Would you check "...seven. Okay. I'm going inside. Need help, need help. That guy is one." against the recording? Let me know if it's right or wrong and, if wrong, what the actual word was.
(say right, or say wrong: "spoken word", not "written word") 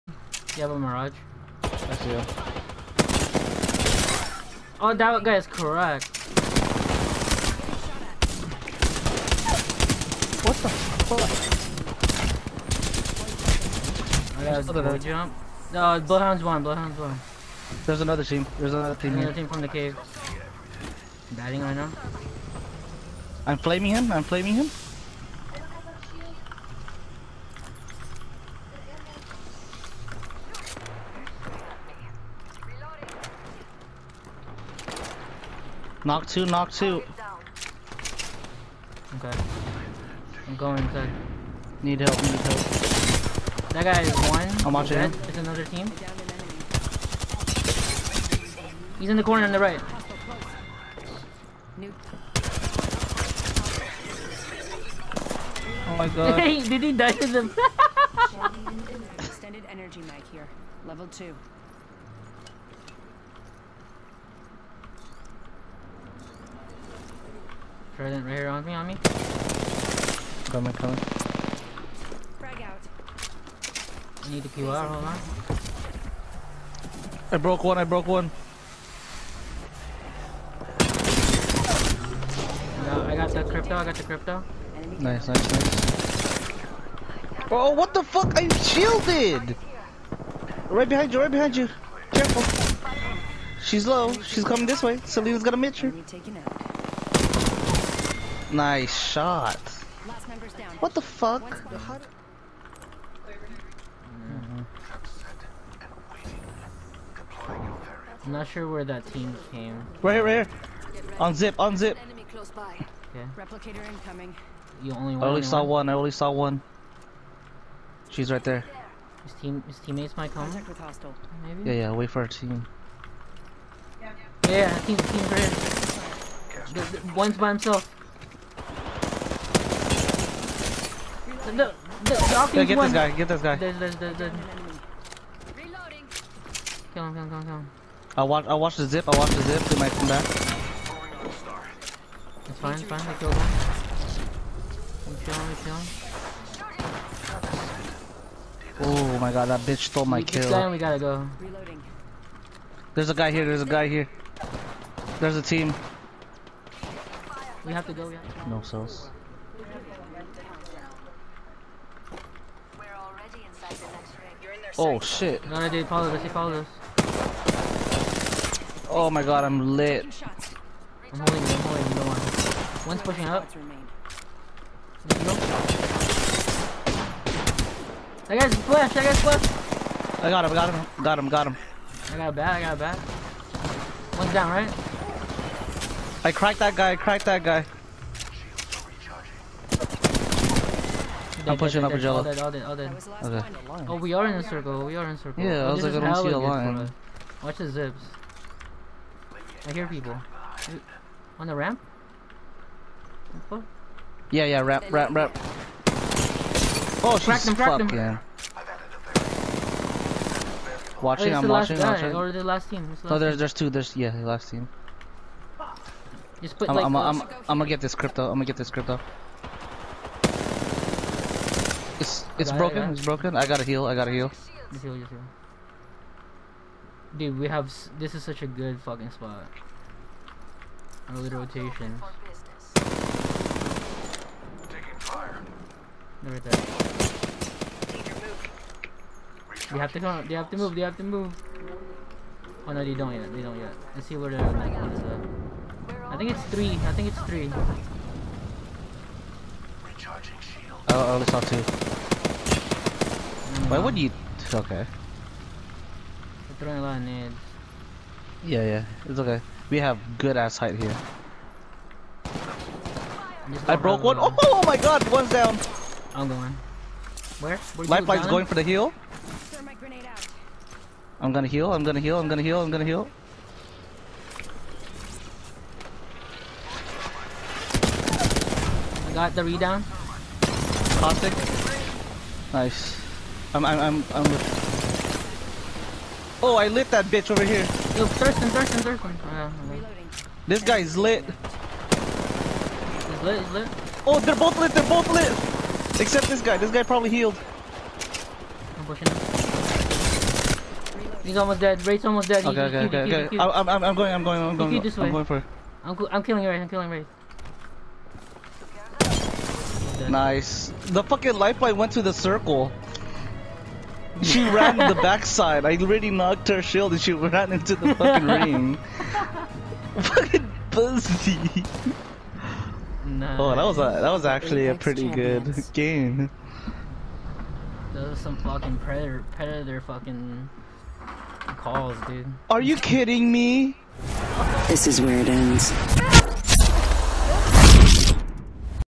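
wrong: "two", not "seven".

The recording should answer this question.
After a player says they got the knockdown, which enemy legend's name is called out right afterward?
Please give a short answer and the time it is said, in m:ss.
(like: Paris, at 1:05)
Caustic, at 4:40.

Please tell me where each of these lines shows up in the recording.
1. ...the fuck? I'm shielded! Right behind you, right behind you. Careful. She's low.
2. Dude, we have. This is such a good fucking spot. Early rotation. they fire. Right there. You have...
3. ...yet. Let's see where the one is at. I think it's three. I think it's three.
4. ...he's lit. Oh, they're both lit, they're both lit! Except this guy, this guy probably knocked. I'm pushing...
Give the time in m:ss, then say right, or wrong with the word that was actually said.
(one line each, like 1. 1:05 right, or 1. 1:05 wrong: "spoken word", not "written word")
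1. 1:27 right
2. 3:47 right
3. 4:03 right
4. 4:53 wrong: "healed", not "knocked".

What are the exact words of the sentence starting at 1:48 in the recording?
I'm not sure where that team came.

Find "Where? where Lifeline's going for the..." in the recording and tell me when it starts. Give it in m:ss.
4:27.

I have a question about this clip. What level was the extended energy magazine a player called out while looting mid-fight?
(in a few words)
Level 2.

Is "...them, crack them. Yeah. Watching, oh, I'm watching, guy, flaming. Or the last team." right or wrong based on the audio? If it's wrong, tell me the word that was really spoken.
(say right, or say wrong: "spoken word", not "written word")
wrong: "watching", not "flaming".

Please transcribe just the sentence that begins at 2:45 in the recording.
No, dude, follow this, he followed us.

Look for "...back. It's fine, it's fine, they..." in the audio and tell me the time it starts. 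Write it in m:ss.
2:20.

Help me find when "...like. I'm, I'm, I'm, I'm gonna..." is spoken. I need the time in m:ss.
3:36.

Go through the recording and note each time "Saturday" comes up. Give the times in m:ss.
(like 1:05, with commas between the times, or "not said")
not said.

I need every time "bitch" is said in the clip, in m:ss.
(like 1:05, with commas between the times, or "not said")
2:29, 4:47.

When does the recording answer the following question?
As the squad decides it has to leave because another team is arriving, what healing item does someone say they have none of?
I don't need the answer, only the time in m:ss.
2:38.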